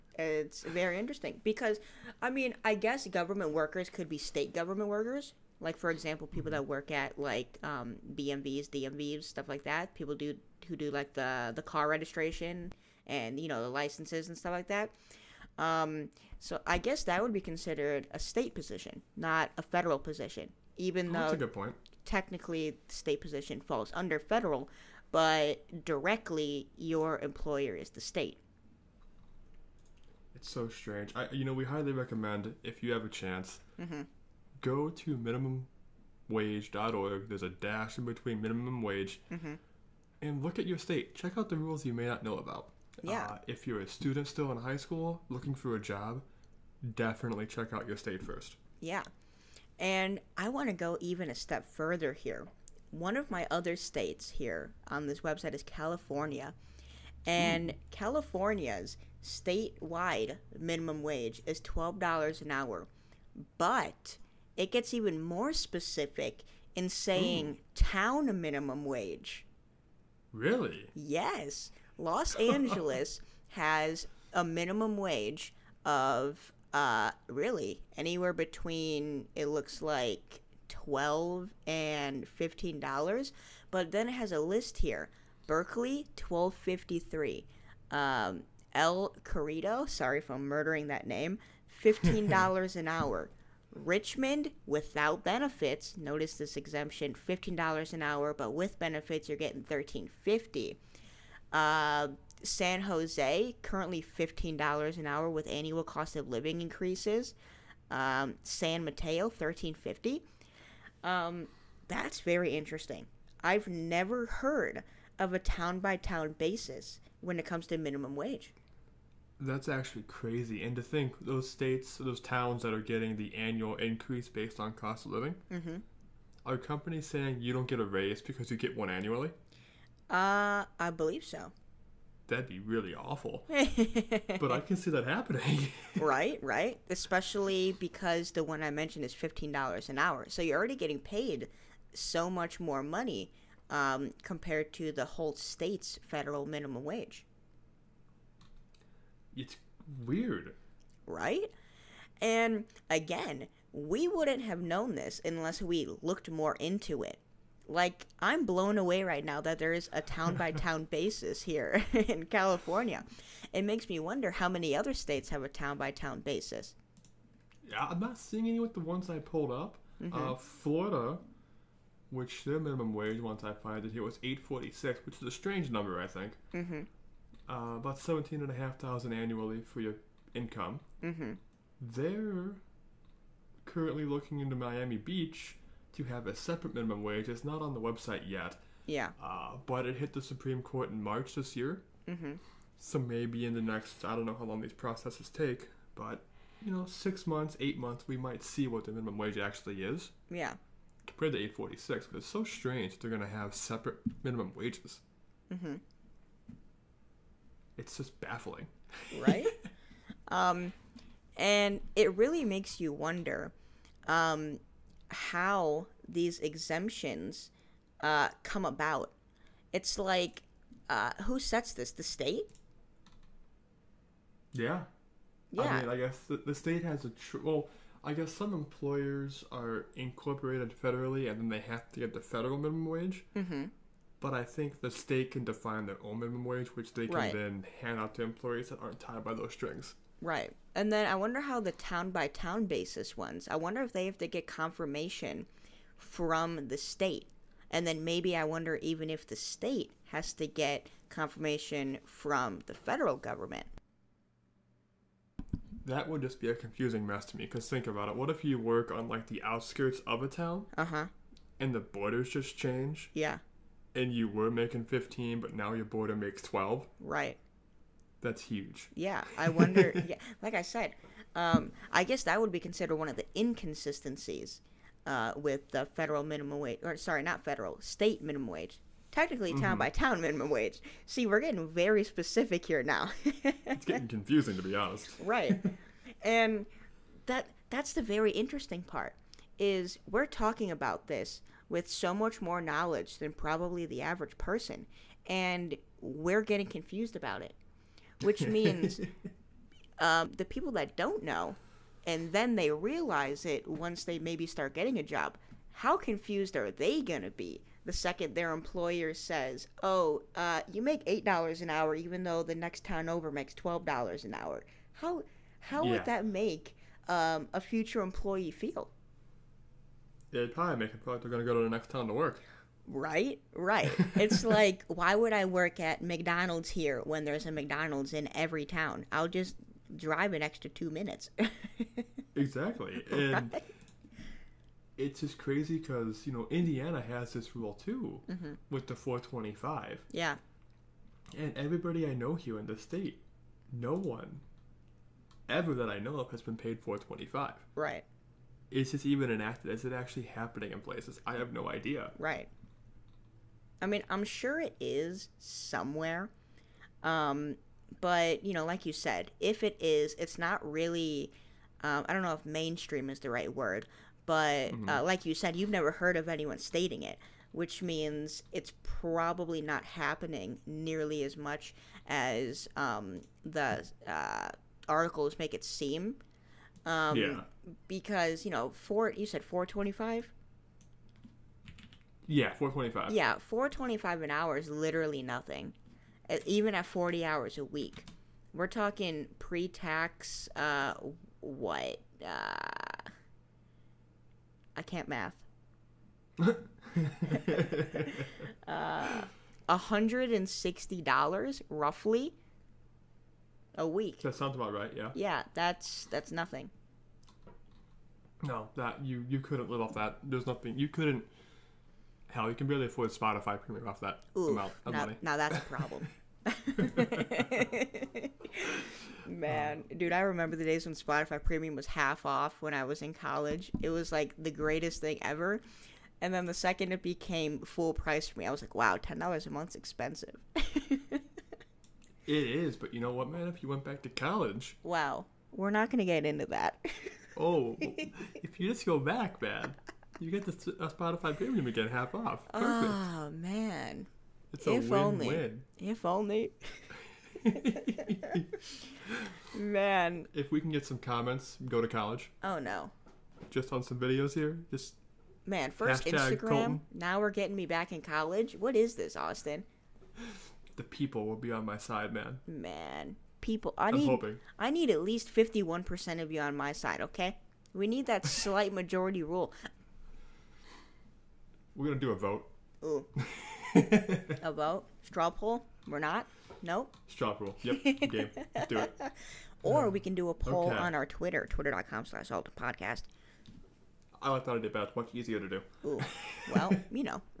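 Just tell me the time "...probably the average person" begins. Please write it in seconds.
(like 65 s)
293 s.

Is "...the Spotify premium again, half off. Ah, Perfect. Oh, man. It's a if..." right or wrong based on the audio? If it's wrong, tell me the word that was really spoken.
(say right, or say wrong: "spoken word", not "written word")
right.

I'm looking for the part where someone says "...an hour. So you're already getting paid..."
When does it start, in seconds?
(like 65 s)
139 s.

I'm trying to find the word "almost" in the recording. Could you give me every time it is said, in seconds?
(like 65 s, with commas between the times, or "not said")
not said.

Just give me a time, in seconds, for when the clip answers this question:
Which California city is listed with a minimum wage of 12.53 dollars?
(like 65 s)
85 s.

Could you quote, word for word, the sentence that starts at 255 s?
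That would just be a confusing mess to me because think about it.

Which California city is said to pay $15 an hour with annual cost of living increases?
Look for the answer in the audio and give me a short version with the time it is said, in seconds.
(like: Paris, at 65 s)
San Jose, at 102 s.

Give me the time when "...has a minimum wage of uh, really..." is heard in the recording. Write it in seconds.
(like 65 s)
73 s.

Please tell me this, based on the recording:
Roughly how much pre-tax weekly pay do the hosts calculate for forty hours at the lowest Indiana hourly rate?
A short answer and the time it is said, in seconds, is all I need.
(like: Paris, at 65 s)
$160, at 399 s.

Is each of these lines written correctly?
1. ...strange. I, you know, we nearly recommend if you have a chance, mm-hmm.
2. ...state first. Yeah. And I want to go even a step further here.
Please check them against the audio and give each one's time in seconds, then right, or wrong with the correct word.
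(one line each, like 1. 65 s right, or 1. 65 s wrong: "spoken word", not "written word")
1. 30 s wrong: "highly", not "nearly"
2. 47 s right.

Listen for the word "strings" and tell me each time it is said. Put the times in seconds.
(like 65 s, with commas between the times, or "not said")
239 s.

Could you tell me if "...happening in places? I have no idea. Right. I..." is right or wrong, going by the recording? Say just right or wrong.
right.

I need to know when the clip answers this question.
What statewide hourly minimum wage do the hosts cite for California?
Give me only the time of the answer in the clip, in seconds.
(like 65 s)
61 s.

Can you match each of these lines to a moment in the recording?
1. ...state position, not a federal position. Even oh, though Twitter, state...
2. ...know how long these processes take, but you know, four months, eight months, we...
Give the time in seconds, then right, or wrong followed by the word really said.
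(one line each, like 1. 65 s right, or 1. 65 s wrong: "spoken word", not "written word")
1. 18 s wrong: "Technically", not "Twitter"
2. 194 s wrong: "six", not "four".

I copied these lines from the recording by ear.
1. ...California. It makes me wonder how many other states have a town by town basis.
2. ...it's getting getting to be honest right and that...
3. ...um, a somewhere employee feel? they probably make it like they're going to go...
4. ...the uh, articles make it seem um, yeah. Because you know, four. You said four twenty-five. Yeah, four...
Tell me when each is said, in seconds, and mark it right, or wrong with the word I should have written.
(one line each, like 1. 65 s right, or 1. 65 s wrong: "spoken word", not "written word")
1. 162 s right
2. 283 s wrong: "confusing", not "getting"
3. 317 s wrong: "future", not "somewhere"
4. 373 s right.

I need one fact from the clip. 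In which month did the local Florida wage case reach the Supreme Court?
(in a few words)
March.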